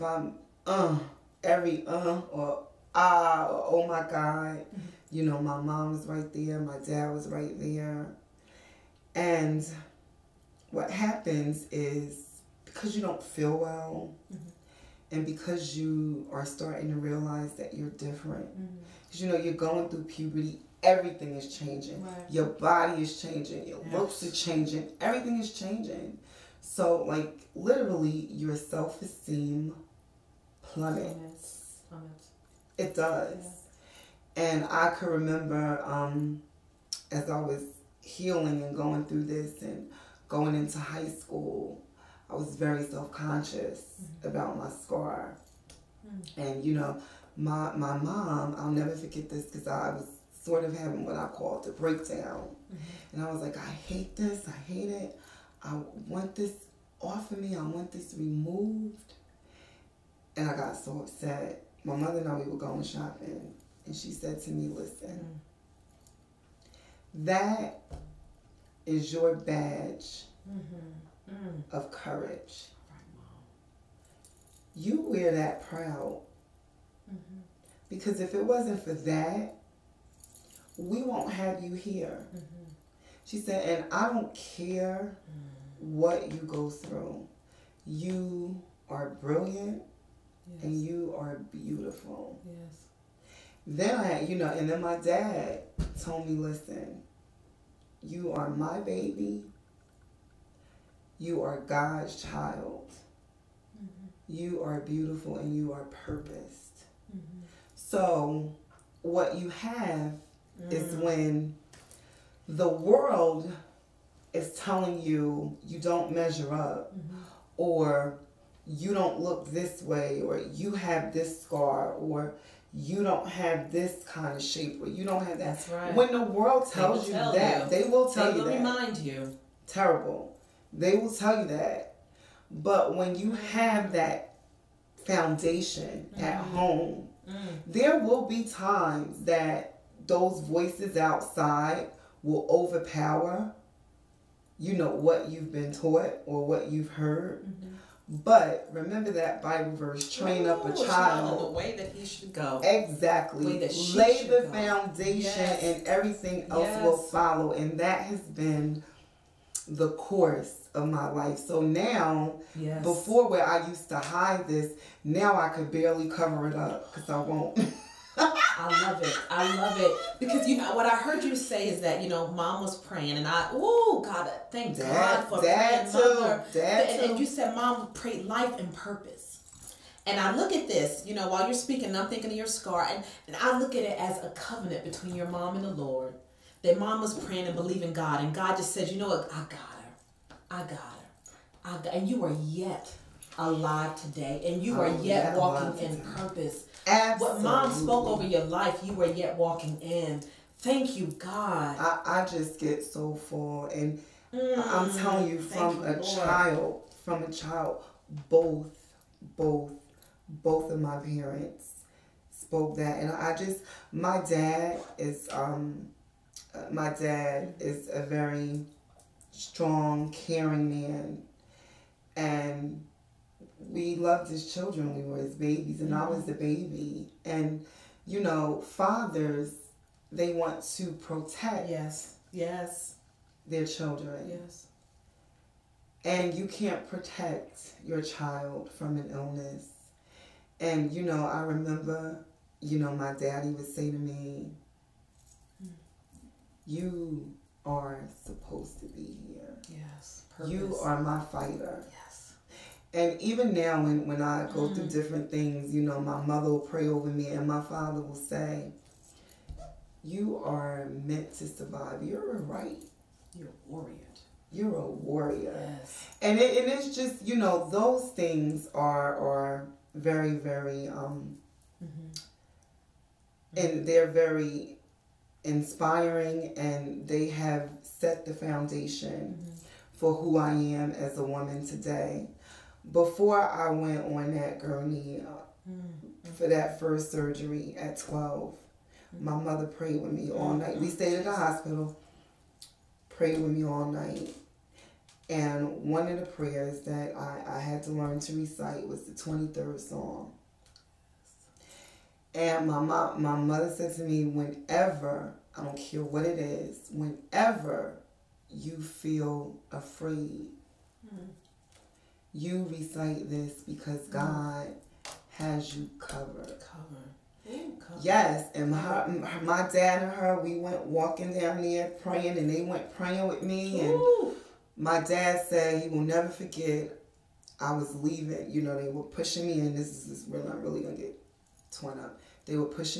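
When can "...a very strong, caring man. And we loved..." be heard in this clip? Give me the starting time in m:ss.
3:37.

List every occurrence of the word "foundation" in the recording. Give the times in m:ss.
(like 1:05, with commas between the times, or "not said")
2:15, 2:34, 4:38.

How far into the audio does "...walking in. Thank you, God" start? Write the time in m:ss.
3:19.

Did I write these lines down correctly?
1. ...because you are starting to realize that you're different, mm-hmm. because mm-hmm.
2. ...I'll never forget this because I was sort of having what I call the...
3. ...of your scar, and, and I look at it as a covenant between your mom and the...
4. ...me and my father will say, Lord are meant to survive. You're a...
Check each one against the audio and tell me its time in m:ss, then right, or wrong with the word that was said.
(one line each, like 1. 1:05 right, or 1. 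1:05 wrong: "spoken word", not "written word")
1. 0:15 right
2. 0:48 right
3. 3:02 right
4. 4:17 wrong: "You", not "Lord".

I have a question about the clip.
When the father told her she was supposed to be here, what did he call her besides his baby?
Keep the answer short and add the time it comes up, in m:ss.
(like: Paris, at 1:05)
my fighter, at 4:11.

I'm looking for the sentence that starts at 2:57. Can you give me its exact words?
and you said mom prayed life and purpose.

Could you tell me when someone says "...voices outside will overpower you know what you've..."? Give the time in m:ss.
2:20.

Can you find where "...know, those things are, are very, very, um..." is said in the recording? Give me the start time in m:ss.
4:27.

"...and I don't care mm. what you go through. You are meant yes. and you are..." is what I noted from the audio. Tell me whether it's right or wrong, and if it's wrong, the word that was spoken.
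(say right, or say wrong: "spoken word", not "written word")
wrong: "brilliant", not "meant".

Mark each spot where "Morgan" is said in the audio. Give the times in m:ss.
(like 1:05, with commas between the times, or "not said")
not said.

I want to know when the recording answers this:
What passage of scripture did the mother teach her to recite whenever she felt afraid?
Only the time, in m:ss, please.
4:59.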